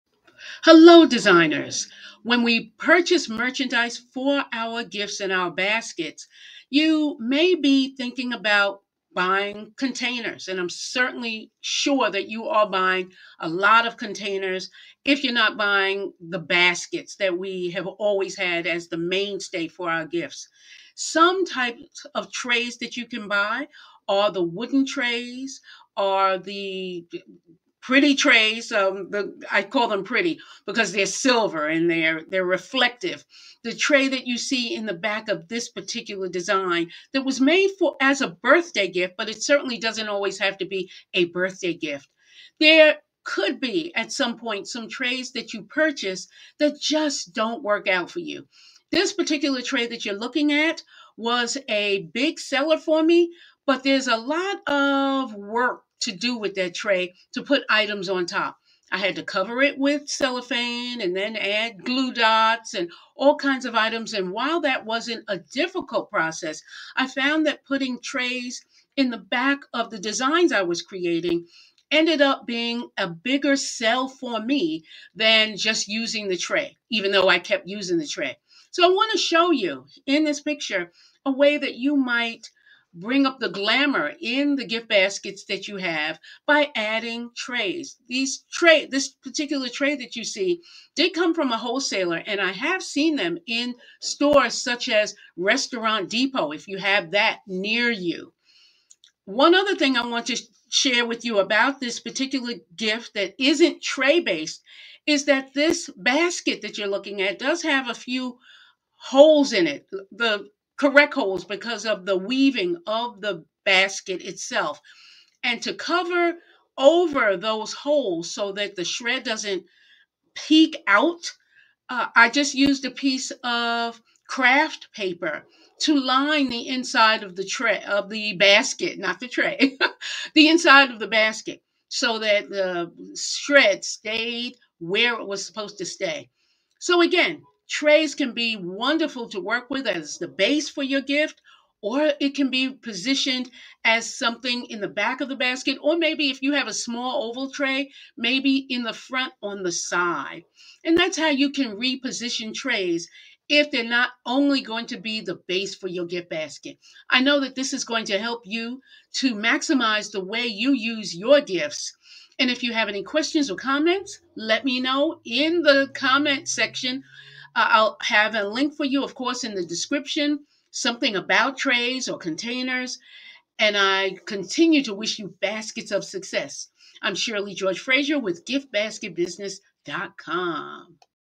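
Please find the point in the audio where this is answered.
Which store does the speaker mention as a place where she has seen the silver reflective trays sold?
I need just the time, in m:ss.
1:35.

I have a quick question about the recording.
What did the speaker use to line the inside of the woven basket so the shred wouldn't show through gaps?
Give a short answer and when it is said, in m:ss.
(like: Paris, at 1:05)
Craft paper, at 2:04.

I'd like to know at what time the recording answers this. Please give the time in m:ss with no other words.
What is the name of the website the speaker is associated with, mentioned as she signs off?
2:58.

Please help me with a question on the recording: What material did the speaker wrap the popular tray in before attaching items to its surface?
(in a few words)
Cellophane.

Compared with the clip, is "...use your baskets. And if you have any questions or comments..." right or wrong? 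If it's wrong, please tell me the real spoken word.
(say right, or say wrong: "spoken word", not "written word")
wrong: "gifts", not "baskets".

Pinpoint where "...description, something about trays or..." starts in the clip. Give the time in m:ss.
2:49.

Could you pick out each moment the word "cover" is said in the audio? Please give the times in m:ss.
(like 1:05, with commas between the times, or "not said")
0:59, 1:55.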